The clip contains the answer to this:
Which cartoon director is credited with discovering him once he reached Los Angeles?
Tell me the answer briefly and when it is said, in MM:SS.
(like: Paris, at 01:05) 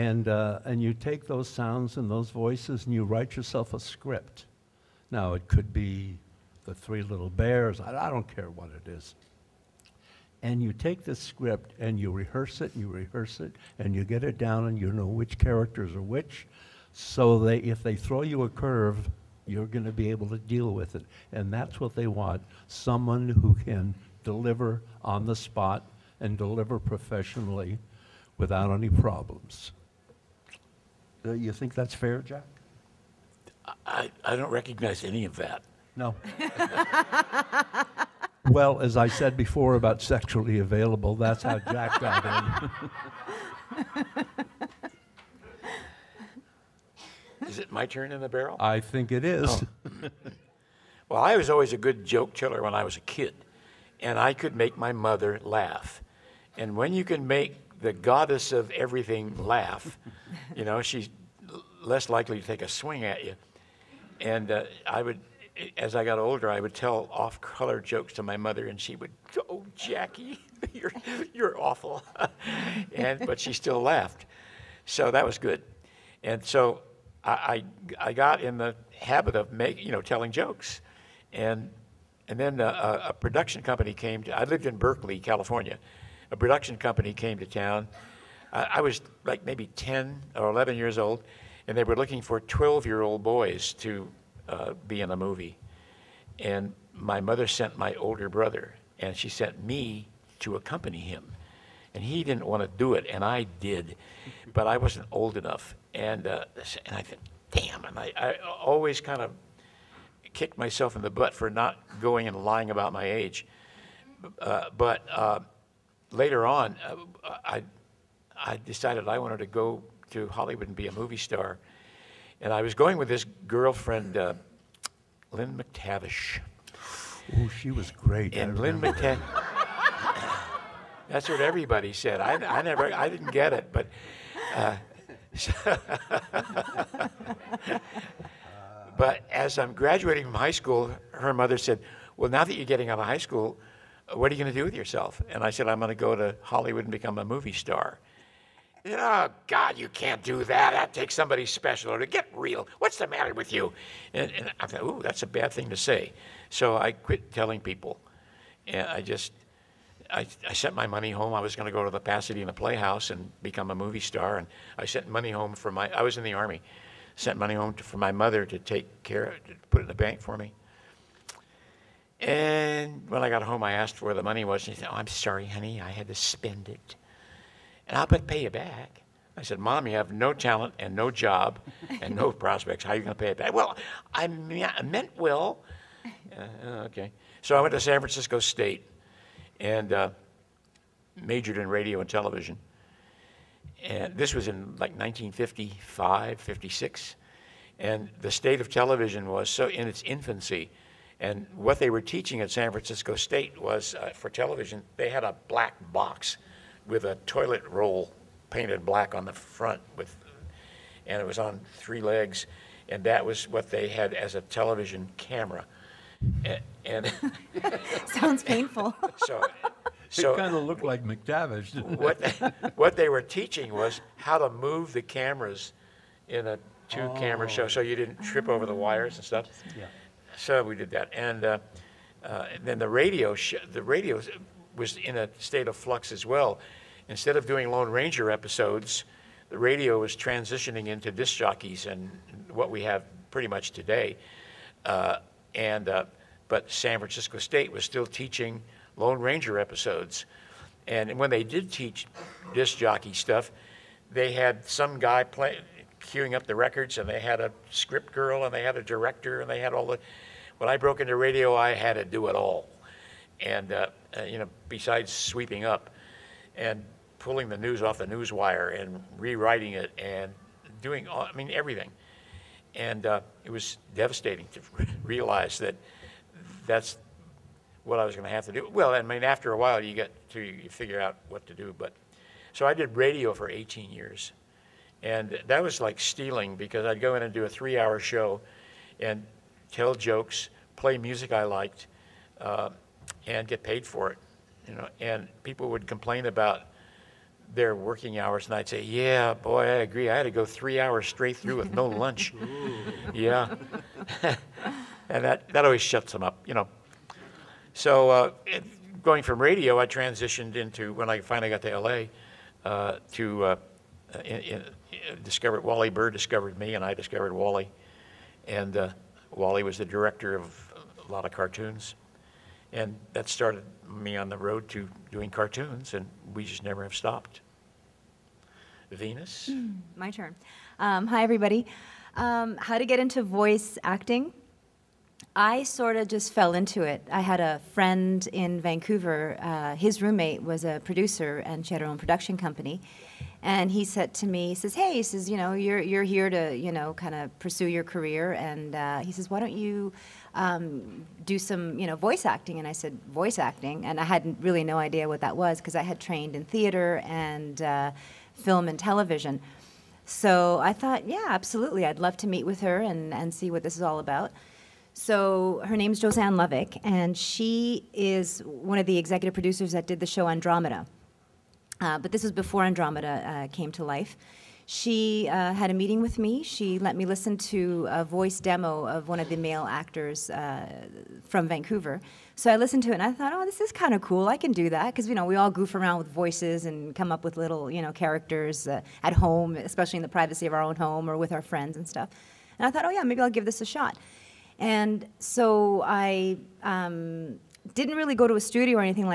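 Wally Burr, at 05:15.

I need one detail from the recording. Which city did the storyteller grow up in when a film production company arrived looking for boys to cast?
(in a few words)
Berkeley.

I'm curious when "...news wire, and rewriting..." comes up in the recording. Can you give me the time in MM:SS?
04:28.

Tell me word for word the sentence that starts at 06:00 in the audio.
So I thought, yeah, absolutely, I'd love to meet with her and and see what this is all about.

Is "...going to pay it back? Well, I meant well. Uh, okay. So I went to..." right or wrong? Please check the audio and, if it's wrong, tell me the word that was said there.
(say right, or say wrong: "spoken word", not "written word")
right.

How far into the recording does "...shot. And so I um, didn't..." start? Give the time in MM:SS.
06:33.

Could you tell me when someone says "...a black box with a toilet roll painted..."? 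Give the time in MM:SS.
03:25.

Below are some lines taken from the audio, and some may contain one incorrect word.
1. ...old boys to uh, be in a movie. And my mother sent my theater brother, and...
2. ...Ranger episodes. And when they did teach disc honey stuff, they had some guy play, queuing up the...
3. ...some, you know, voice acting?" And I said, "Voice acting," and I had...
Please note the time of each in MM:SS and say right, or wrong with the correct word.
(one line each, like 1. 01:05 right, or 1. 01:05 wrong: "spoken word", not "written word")
1. 01:33 wrong: "older", not "theater"
2. 04:09 wrong: "jockey", not "honey"
3. 05:51 right.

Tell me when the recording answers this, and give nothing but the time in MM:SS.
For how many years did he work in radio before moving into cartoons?
04:43.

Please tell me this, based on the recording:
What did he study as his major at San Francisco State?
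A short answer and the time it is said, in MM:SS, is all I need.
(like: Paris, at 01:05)
radio and television, at 03:11.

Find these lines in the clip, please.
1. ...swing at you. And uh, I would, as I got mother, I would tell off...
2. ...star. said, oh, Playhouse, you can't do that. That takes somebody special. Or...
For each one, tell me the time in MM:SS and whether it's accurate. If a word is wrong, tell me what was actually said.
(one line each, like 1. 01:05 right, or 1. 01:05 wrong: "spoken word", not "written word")
1. 01:02 wrong: "older", not "mother"
2. 02:27 wrong: "God", not "Playhouse".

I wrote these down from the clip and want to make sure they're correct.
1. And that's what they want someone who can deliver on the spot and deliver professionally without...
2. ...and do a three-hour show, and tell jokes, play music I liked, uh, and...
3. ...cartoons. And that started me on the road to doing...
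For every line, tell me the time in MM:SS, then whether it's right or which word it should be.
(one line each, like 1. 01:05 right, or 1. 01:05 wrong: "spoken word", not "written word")
1. 00:21 right
2. 04:47 right
3. 05:21 right.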